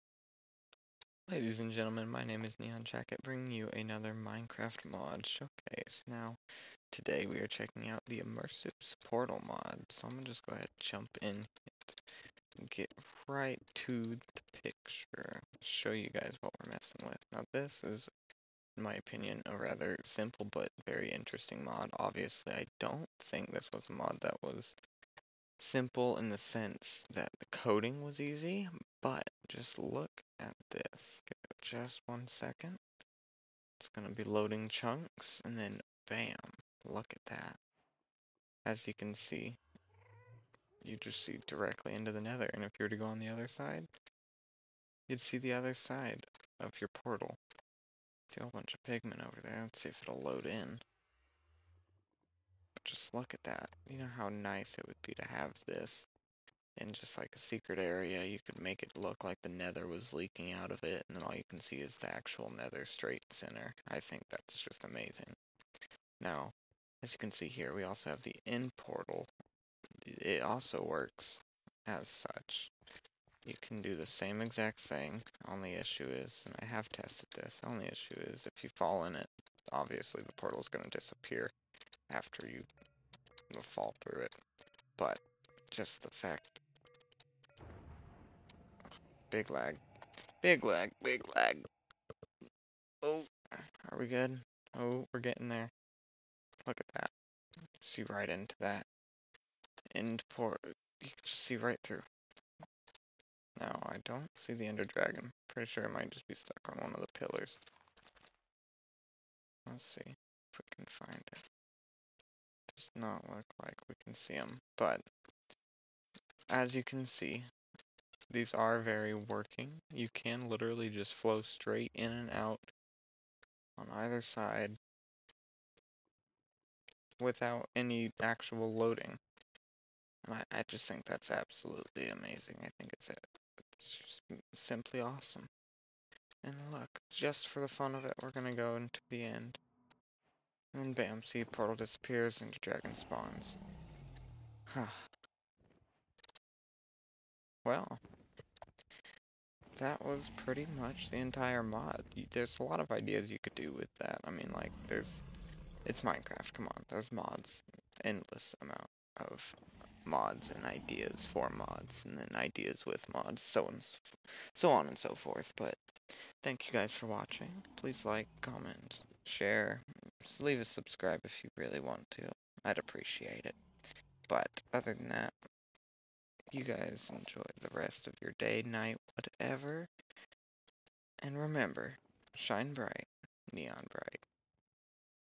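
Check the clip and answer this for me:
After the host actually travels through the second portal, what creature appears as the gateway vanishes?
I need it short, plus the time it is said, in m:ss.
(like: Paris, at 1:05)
the dragon, at 2:22.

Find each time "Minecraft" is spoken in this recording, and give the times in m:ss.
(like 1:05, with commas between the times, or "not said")
0:04, 2:36.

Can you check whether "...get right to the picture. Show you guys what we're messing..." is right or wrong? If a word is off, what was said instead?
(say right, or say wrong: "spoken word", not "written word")
right.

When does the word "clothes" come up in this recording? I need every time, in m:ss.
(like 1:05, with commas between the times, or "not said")
not said.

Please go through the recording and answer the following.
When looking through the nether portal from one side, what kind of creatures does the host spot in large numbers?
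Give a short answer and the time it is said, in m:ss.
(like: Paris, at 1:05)
pigmen, at 0:48.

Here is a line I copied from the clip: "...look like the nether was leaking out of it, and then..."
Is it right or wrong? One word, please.
right.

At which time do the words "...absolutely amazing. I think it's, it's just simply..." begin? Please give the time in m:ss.
2:11.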